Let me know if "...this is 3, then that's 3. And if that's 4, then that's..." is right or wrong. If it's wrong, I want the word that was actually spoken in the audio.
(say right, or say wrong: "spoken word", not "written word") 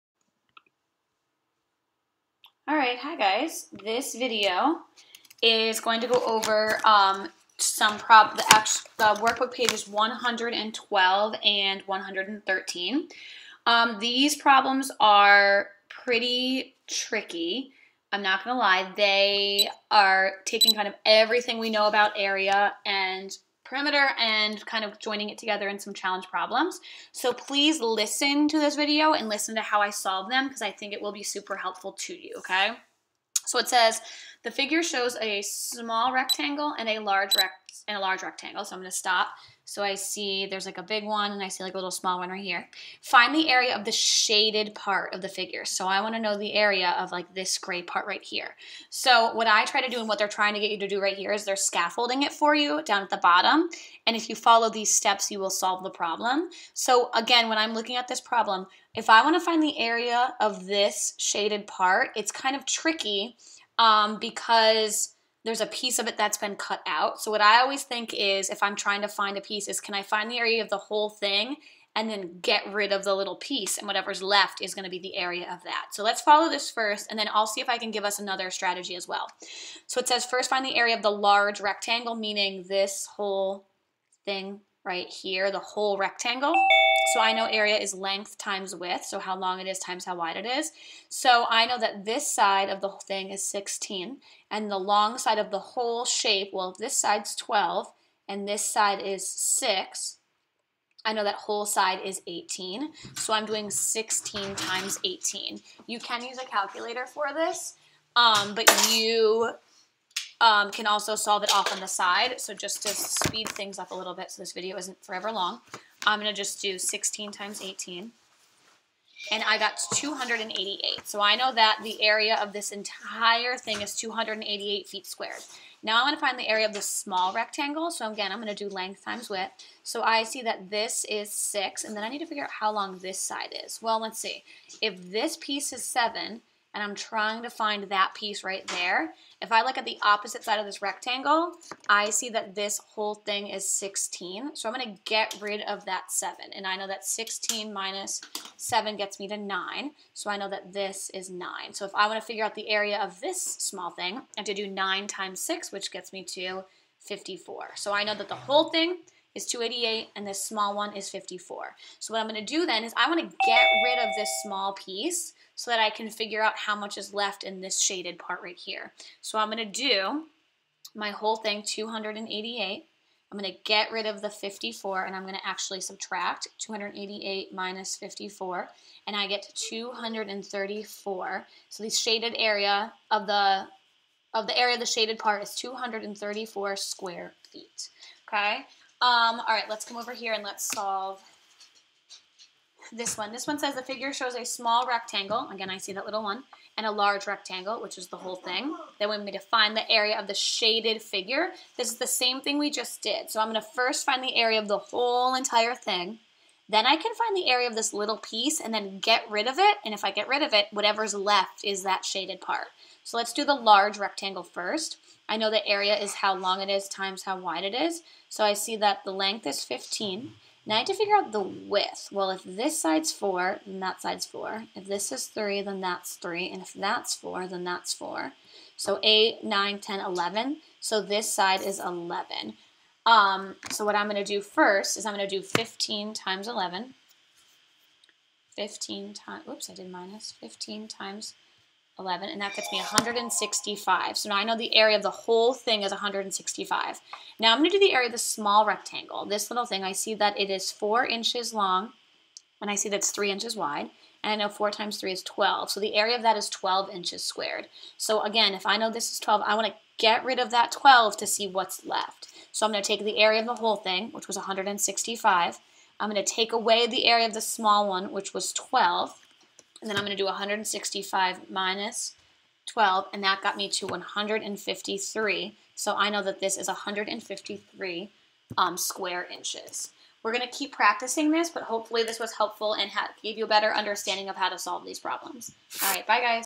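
right.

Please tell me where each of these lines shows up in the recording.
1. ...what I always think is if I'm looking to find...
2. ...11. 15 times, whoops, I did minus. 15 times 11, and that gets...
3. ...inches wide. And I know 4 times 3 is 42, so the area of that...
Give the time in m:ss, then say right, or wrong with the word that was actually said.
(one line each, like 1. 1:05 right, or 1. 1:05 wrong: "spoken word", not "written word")
1. 1:07 wrong: "trying", not "looking"
2. 3:56 right
3. 4:13 wrong: "12", not "42".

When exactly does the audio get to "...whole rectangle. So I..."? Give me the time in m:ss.
1:25.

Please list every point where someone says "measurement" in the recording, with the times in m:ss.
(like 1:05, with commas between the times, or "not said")
not said.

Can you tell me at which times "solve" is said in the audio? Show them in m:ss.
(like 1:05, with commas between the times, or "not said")
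0:29, 0:55, 1:51, 3:10, 4:44.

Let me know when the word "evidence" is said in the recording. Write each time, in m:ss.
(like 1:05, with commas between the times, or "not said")
not said.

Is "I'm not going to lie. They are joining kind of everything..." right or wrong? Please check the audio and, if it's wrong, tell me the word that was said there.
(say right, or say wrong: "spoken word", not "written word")
wrong: "taking", not "joining".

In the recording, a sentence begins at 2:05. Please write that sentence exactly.
Now I want to find the area of the small rectangle.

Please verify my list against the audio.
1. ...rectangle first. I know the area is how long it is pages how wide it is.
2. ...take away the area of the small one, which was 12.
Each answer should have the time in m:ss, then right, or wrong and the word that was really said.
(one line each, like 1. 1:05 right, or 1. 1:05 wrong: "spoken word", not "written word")
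1. 3:33 wrong: "times", not "pages"
2. 4:26 right.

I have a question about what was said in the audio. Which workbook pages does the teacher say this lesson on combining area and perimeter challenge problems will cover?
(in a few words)
112 and 113.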